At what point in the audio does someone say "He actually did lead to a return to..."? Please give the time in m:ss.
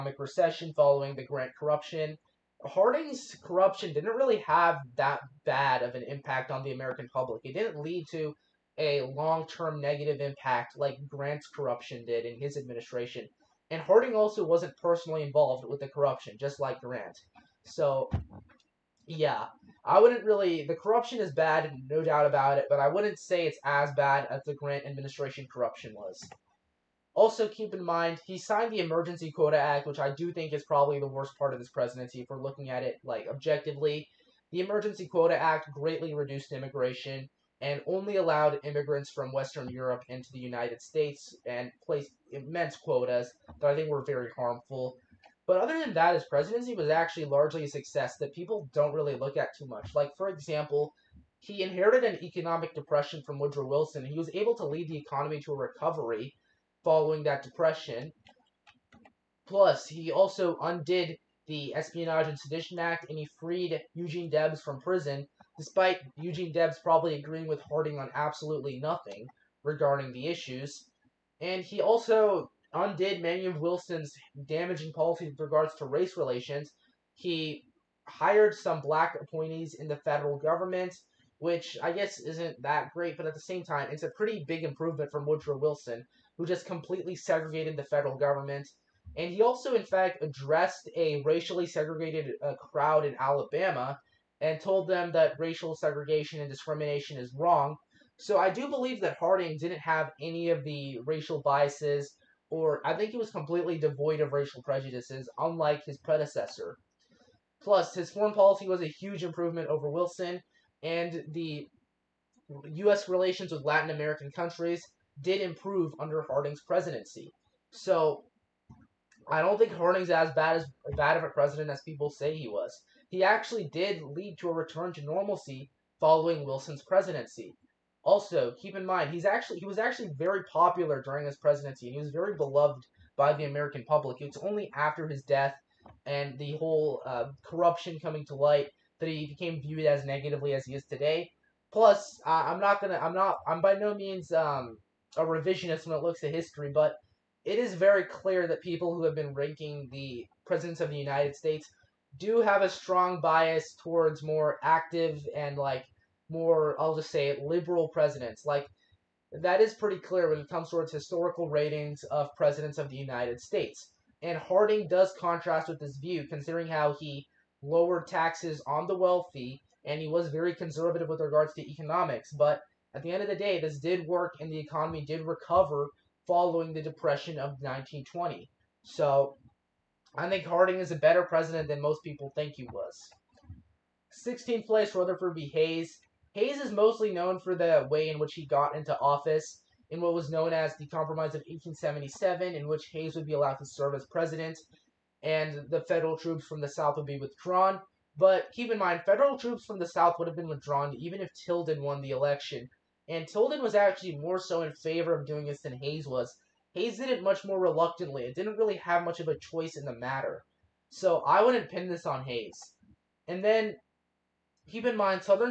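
2:03.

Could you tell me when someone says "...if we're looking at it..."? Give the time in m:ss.
0:32.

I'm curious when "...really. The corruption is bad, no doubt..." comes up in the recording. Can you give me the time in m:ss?
0:20.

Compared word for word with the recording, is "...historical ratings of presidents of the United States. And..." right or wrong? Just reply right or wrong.
right.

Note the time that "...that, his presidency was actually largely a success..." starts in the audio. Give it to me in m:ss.
0:45.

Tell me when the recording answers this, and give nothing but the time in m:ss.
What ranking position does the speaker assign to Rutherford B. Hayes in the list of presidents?
3:04.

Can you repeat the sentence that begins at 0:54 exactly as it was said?
He was able to lead the economy to a recovery following that depression.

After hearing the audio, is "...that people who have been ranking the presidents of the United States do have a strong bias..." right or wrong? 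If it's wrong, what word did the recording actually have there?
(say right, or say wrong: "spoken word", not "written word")
right.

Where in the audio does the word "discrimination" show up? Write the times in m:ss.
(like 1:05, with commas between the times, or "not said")
1:36.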